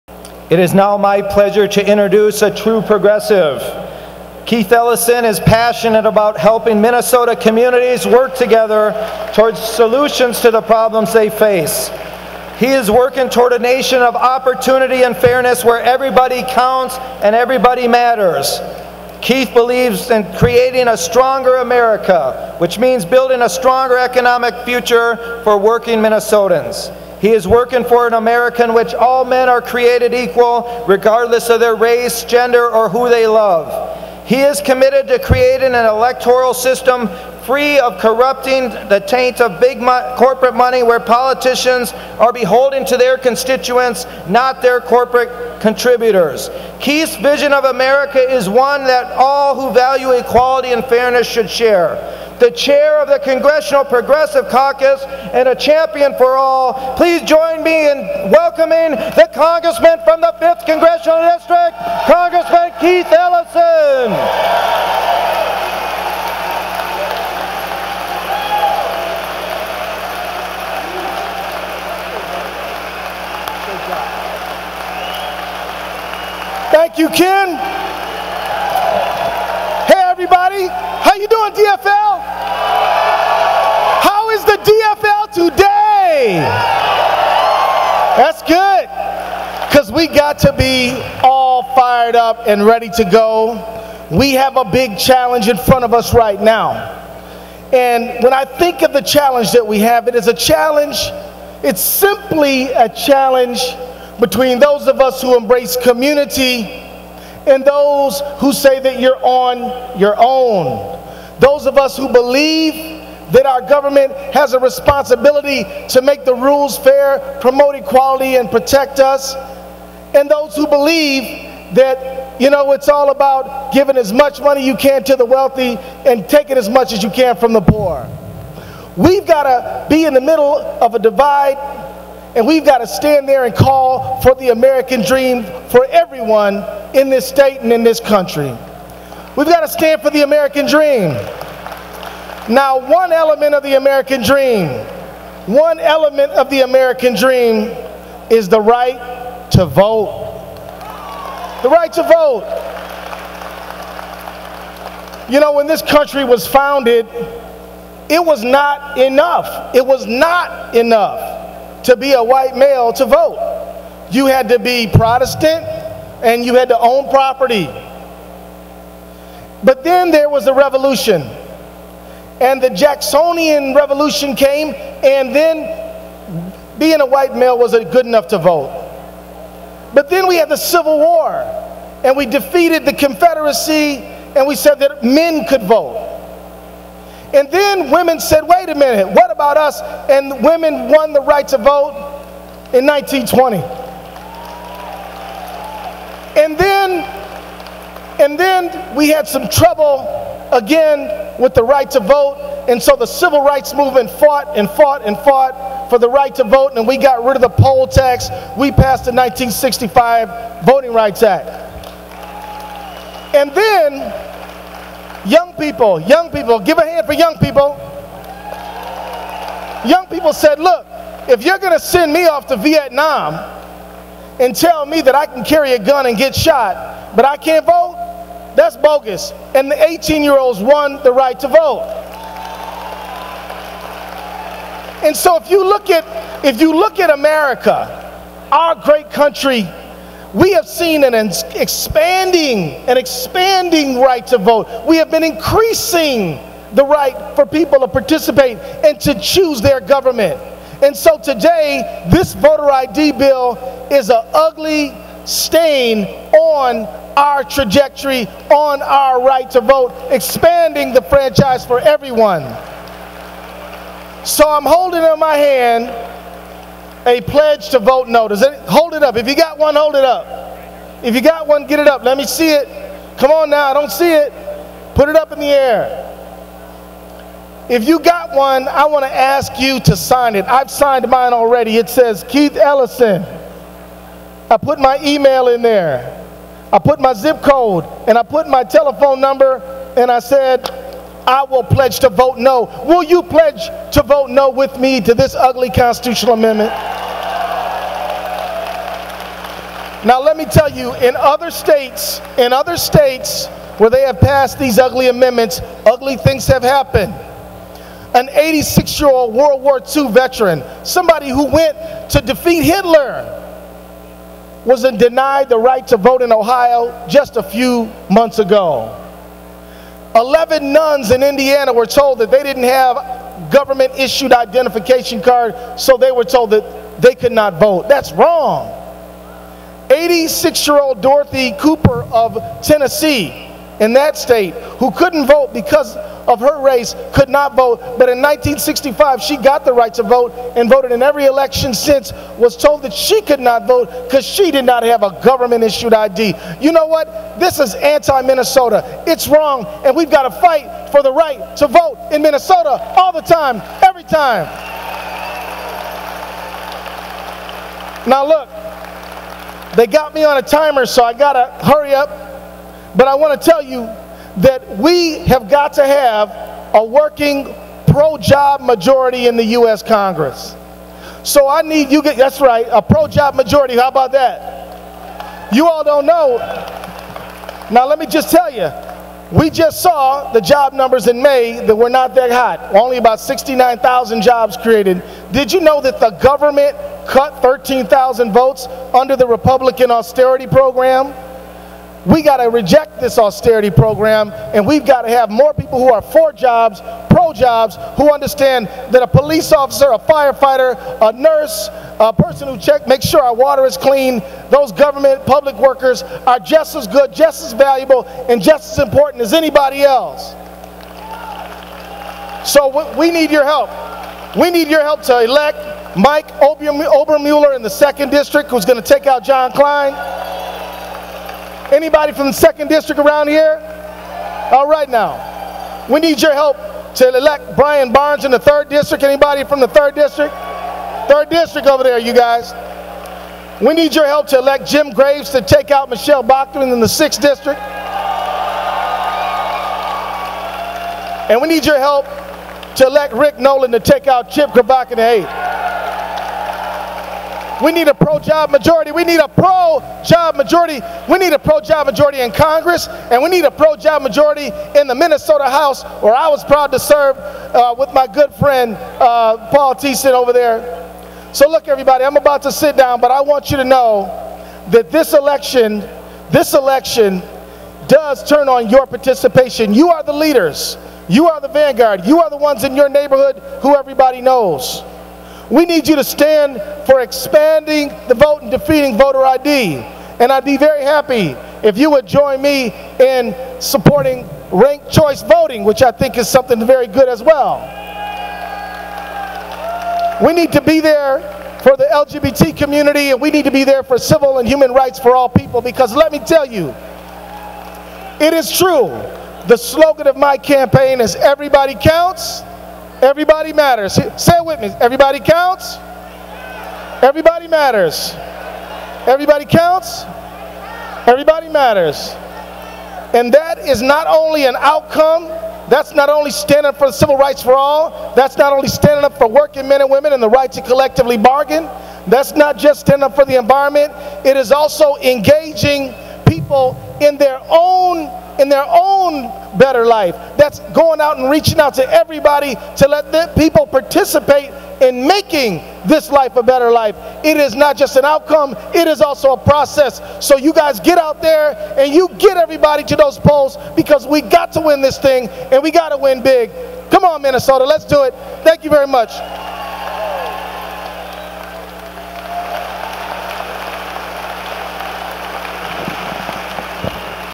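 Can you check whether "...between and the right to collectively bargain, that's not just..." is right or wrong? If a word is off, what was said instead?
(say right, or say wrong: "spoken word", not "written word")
wrong: "women", not "between".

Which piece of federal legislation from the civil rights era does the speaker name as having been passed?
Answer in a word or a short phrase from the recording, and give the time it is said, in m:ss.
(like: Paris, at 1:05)
1965 Voting Rights Act, at 3:29.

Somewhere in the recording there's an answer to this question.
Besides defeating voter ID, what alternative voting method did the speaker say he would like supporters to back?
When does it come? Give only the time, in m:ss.
8:04.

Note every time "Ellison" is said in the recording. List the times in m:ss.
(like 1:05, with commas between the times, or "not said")
0:04, 1:03, 4:42.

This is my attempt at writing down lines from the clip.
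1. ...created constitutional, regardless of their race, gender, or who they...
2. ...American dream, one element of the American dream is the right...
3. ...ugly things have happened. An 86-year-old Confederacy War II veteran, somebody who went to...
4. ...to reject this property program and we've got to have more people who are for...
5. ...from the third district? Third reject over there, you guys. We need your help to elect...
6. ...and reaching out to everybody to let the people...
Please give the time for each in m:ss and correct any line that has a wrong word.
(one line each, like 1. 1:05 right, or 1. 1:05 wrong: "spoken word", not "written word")
1. 0:29 wrong: "equal", not "constitutional"
2. 2:23 right
3. 5:05 wrong: "World", not "Confederacy"
4. 6:32 wrong: "austerity", not "property"
5. 7:09 wrong: "district", not "reject"
6. 8:51 right.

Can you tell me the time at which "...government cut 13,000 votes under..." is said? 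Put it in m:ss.
6:26.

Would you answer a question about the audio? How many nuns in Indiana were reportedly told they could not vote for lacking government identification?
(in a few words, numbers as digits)
11.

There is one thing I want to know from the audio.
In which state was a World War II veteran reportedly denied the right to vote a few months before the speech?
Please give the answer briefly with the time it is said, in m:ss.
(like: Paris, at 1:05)
Ohio, at 5:16.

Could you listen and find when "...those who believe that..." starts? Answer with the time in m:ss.
2:00.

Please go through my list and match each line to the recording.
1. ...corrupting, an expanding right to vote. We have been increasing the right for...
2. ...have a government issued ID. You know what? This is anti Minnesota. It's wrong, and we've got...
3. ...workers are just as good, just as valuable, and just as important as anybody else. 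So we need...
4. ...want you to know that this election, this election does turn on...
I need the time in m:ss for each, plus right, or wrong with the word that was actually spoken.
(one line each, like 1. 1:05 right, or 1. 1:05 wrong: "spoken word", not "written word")
1. 4:01 wrong: "expanding", not "corrupting"
2. 5:44 right
3. 6:45 right
4. 7:43 right.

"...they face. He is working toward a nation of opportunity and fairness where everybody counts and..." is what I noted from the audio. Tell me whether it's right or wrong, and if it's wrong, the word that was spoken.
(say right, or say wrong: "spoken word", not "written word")
right.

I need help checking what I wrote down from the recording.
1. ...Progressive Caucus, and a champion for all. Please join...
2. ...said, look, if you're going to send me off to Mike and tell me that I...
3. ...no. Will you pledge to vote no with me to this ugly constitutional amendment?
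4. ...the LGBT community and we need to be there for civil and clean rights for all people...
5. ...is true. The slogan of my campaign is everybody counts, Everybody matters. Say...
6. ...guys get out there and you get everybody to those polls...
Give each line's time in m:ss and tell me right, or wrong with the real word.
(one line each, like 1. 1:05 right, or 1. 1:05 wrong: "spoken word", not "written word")
1. 0:53 right
2. 3:40 wrong: "Vietnam", not "Mike"
3. 4:52 right
4. 8:11 wrong: "human", not "clean"
5. 8:18 right
6. 9:00 right.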